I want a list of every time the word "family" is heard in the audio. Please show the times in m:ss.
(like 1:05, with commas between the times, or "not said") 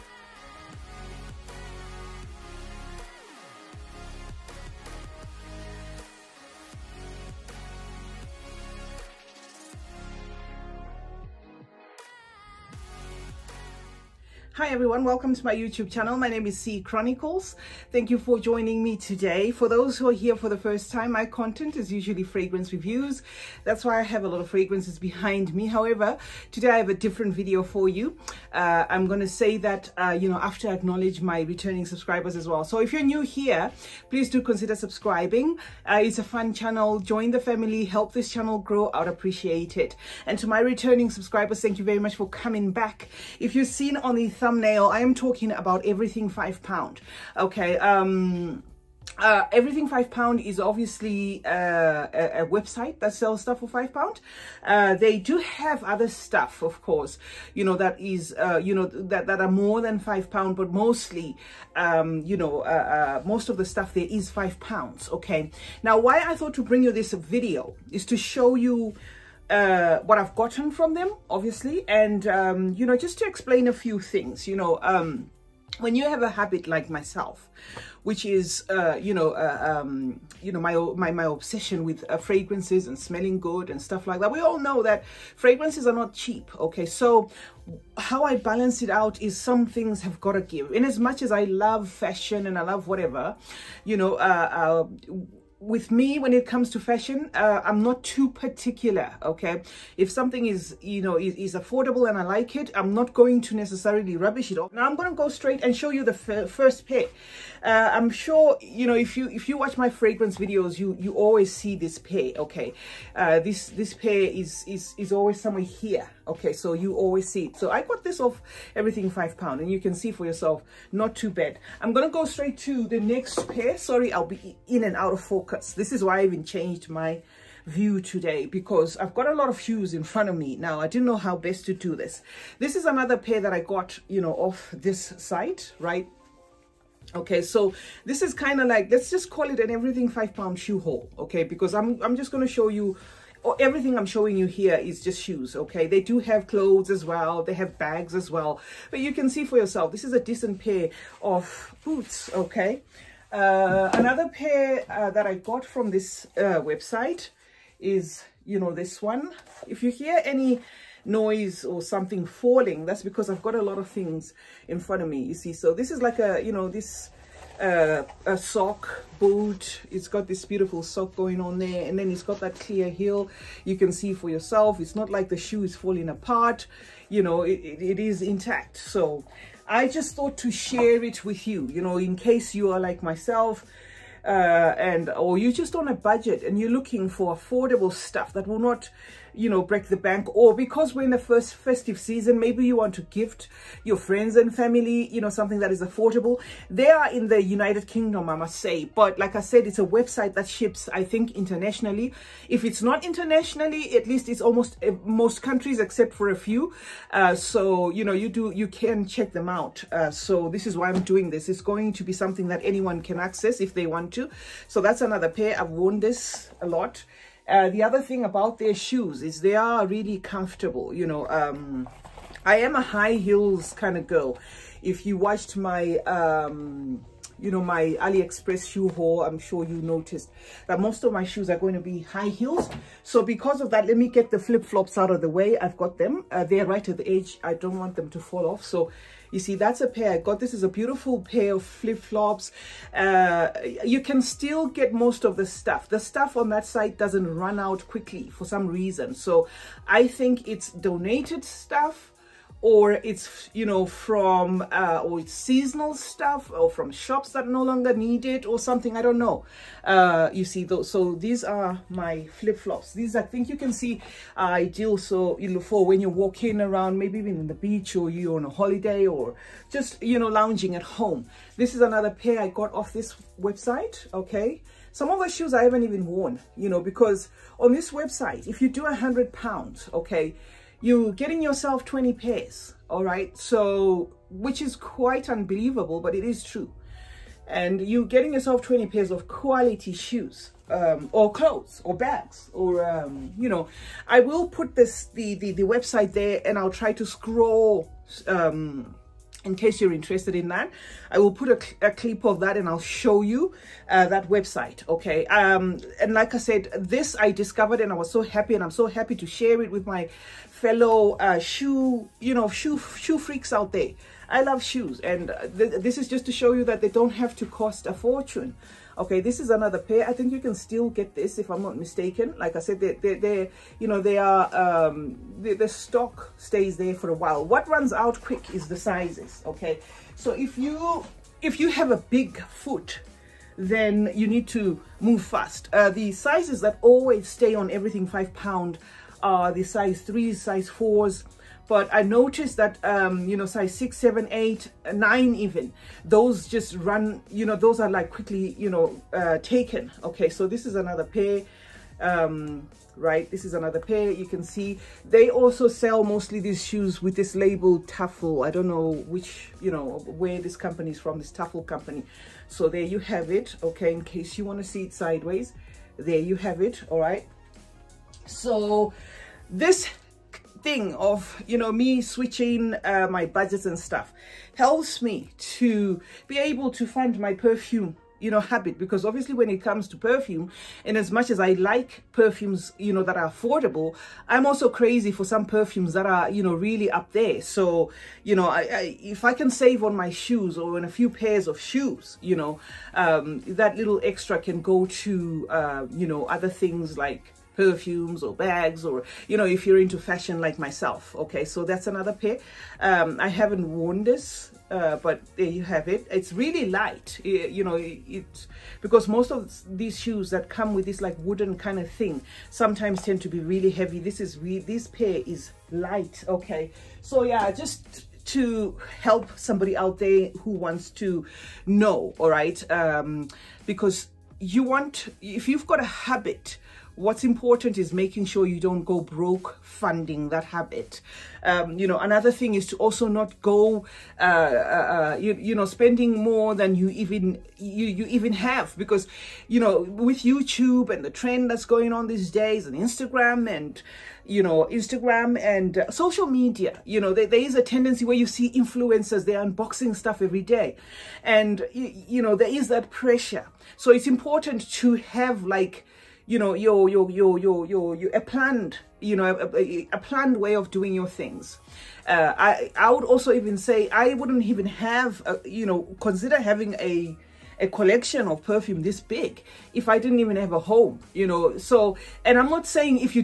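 0:37, 3:14.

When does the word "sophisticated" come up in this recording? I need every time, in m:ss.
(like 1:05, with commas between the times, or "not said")
not said.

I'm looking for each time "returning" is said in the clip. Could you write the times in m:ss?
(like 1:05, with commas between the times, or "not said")
0:31, 0:40.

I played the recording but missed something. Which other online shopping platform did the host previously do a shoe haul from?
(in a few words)
AliExpress.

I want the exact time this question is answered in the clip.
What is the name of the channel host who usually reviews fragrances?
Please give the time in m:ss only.
0:16.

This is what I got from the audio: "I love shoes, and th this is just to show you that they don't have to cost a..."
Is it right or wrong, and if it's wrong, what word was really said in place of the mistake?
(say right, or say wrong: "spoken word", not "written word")
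right.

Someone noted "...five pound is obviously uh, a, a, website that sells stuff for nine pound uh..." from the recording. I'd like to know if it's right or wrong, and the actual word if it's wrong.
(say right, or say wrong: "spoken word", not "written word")
wrong: "five", not "nine".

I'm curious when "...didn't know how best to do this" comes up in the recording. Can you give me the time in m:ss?
2:10.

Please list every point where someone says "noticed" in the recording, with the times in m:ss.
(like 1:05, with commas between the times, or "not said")
3:49, 5:42.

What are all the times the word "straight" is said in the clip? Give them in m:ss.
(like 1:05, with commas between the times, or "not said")
1:45, 2:02.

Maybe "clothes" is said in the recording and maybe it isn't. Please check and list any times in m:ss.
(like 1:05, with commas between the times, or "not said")
2:26, 4:51.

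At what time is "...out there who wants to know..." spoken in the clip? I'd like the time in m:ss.
6:59.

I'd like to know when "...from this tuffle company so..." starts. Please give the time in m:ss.
6:00.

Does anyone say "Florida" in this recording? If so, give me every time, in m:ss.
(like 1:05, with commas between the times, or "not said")
not said.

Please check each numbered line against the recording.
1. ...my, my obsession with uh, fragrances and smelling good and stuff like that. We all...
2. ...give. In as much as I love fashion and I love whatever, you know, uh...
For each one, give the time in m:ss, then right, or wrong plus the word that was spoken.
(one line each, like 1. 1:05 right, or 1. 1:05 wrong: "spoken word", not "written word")
1. 1:20 right
2. 1:30 right.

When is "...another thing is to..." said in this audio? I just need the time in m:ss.
7:11.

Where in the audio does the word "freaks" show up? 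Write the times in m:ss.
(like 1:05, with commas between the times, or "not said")
5:13.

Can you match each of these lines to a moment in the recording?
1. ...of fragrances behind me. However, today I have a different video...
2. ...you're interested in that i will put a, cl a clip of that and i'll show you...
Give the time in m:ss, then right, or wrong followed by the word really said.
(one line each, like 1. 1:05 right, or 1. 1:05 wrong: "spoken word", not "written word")
1. 0:24 right
2. 4:59 right.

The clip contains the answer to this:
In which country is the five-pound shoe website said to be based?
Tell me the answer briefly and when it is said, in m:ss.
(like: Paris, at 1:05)
United Kingdom, at 3:17.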